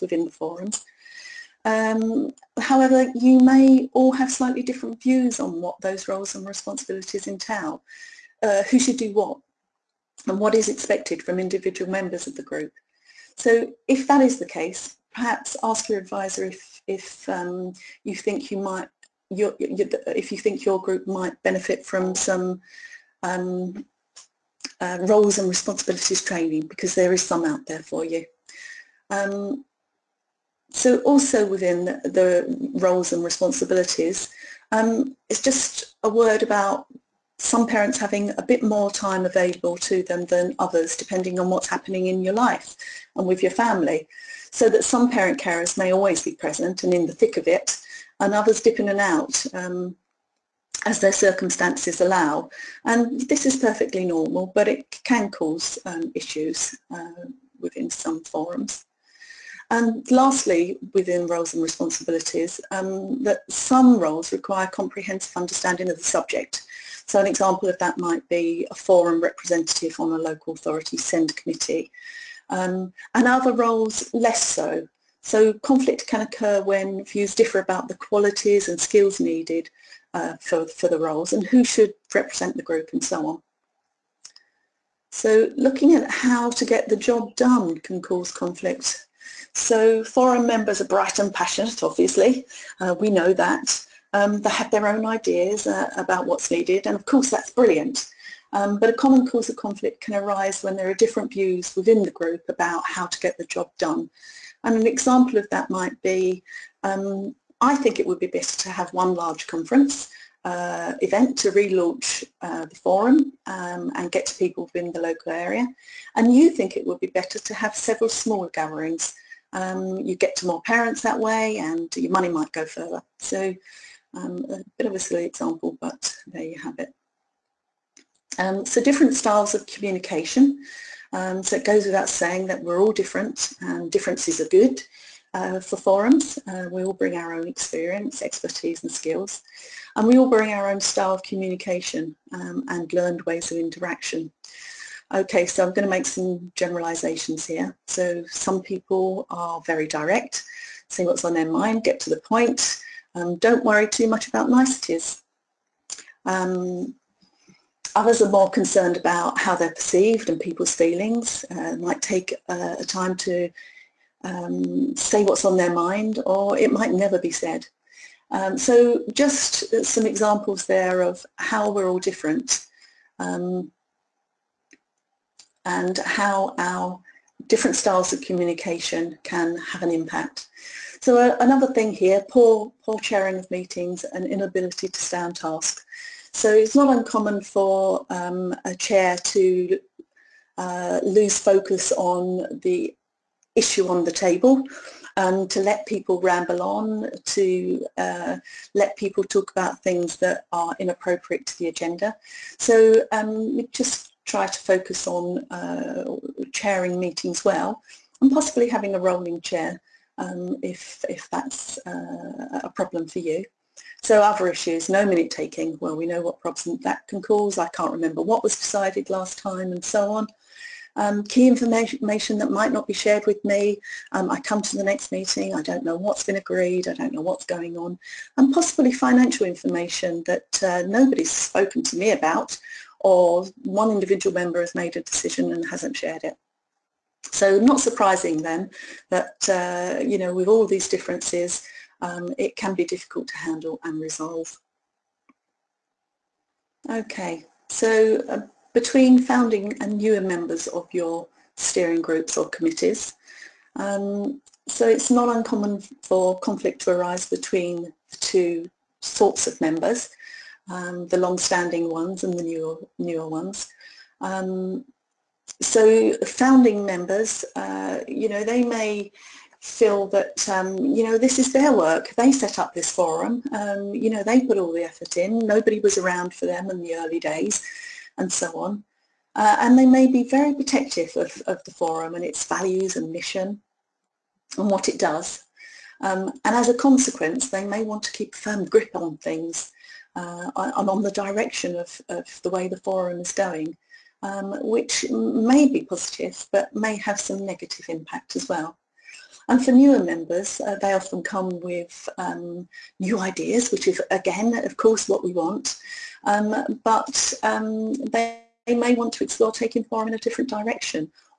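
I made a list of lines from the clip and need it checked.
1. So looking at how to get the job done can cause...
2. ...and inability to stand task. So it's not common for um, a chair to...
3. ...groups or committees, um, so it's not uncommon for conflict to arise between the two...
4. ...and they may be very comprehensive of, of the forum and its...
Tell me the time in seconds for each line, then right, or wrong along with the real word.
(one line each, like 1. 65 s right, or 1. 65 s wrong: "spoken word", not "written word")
1. 85 s right
2. 184 s wrong: "uncommon", not "common"
3. 252 s right
4. 279 s wrong: "protective", not "comprehensive".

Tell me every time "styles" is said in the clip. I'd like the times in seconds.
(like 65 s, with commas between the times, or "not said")
129 s, 140 s, 177 s.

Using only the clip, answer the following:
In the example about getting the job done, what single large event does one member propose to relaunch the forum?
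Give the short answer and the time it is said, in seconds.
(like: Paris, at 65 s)
One large conference, at 108 s.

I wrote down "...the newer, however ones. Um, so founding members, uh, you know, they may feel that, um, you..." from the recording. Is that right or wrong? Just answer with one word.
wrong.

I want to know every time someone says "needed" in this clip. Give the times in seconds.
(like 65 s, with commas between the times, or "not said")
79 s, 96 s.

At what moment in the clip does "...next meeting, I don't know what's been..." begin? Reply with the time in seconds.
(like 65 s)
224 s.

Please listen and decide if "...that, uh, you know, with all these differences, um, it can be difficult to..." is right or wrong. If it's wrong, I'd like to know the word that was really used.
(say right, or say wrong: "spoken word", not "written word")
right.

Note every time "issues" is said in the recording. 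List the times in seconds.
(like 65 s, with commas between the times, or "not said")
56 s, 193 s, 214 s.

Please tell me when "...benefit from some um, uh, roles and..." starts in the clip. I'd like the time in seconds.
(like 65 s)
21 s.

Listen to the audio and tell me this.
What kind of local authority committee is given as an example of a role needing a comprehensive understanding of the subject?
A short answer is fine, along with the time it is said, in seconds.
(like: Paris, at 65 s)
SEND committee, at 70 s.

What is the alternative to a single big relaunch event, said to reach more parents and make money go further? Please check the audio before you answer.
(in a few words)
Several smaller gatherings.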